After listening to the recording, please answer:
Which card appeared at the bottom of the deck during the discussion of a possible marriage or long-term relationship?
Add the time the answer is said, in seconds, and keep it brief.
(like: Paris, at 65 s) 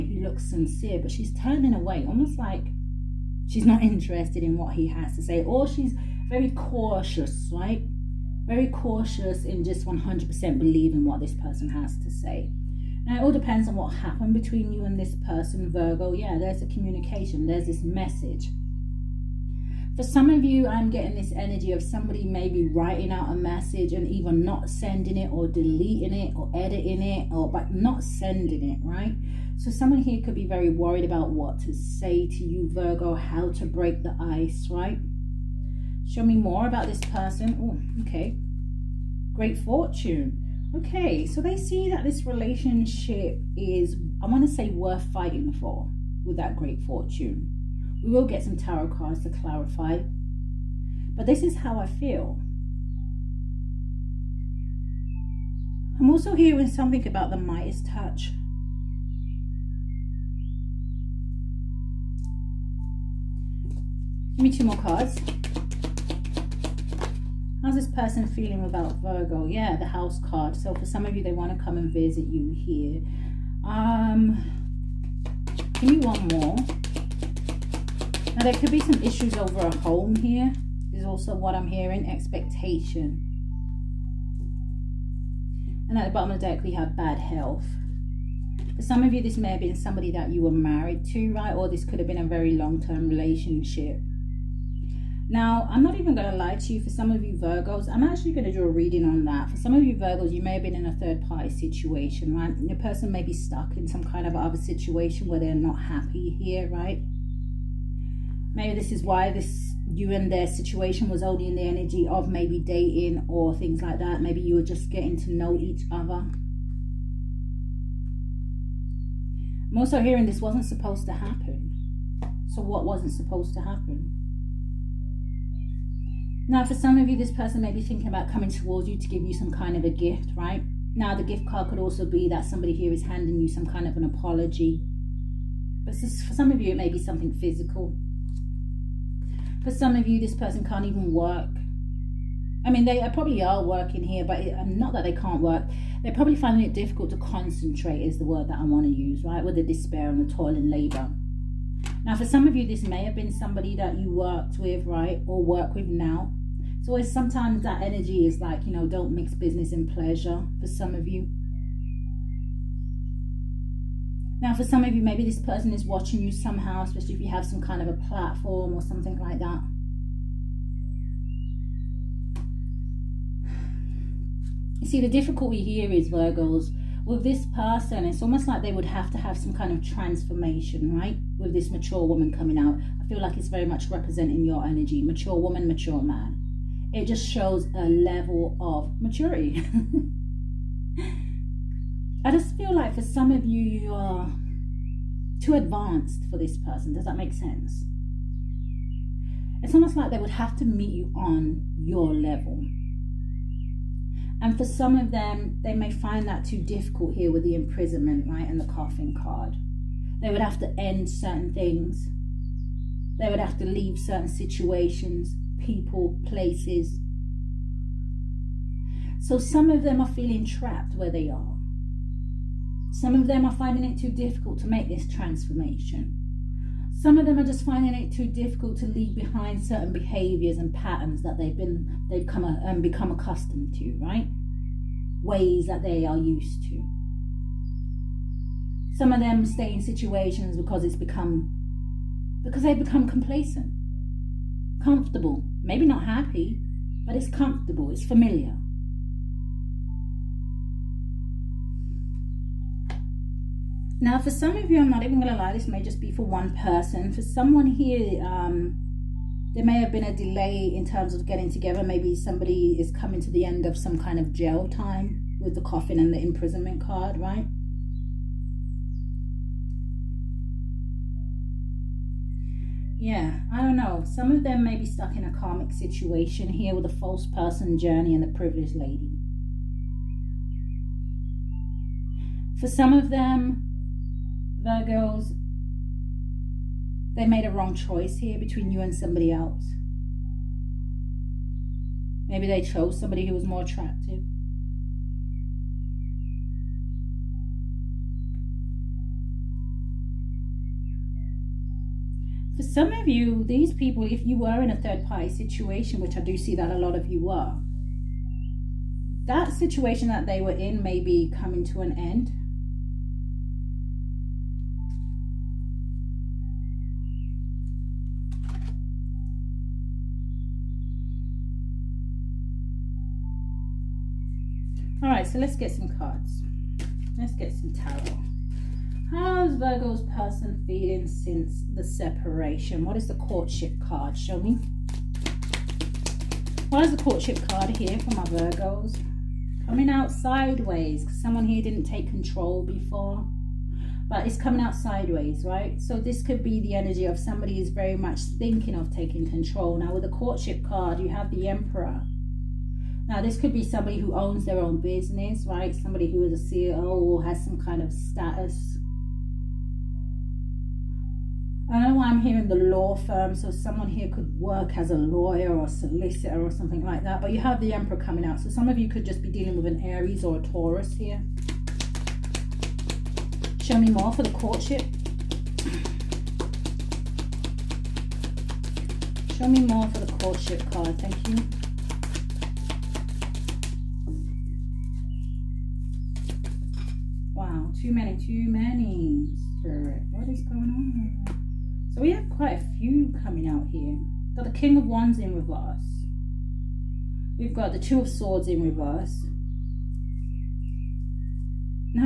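Bad health, at 86 s.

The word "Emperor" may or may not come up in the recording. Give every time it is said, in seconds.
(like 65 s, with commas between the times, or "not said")
351 s, 367 s.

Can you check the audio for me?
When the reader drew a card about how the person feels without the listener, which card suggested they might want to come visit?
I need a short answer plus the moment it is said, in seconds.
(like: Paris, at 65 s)
The house card, at 69 s.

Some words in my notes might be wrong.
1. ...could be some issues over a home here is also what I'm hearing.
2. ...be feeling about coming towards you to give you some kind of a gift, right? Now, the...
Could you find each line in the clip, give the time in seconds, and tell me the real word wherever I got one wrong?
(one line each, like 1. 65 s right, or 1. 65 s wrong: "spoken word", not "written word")
1. 78 s right
2. 127 s wrong: "thinking", not "feeling".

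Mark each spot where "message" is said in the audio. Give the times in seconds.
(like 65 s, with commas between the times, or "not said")
17 s, 23 s.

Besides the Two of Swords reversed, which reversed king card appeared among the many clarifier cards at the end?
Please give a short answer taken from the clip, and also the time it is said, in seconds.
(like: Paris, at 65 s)
King of Wands, at 394 s.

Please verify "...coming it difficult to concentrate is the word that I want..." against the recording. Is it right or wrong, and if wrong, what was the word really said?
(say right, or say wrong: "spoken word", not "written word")
wrong: "finding", not "coming".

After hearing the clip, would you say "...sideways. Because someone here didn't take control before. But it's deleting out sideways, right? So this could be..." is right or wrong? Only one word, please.
wrong.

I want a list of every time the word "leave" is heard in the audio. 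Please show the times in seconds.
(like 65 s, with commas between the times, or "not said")
213 s, 228 s.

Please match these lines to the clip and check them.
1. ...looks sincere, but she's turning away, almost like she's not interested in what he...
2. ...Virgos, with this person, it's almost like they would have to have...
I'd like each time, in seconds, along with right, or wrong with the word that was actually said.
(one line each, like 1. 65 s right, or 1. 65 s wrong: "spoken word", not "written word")
1. 0 s right
2. 176 s right.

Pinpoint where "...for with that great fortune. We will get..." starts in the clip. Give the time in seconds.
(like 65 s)
45 s.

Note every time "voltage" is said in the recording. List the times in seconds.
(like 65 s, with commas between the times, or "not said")
not said.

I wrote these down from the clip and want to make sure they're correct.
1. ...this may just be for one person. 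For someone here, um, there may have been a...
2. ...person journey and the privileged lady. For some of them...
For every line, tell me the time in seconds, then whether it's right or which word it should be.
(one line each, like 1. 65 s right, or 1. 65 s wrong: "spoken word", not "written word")
1. 255 s right
2. 277 s right.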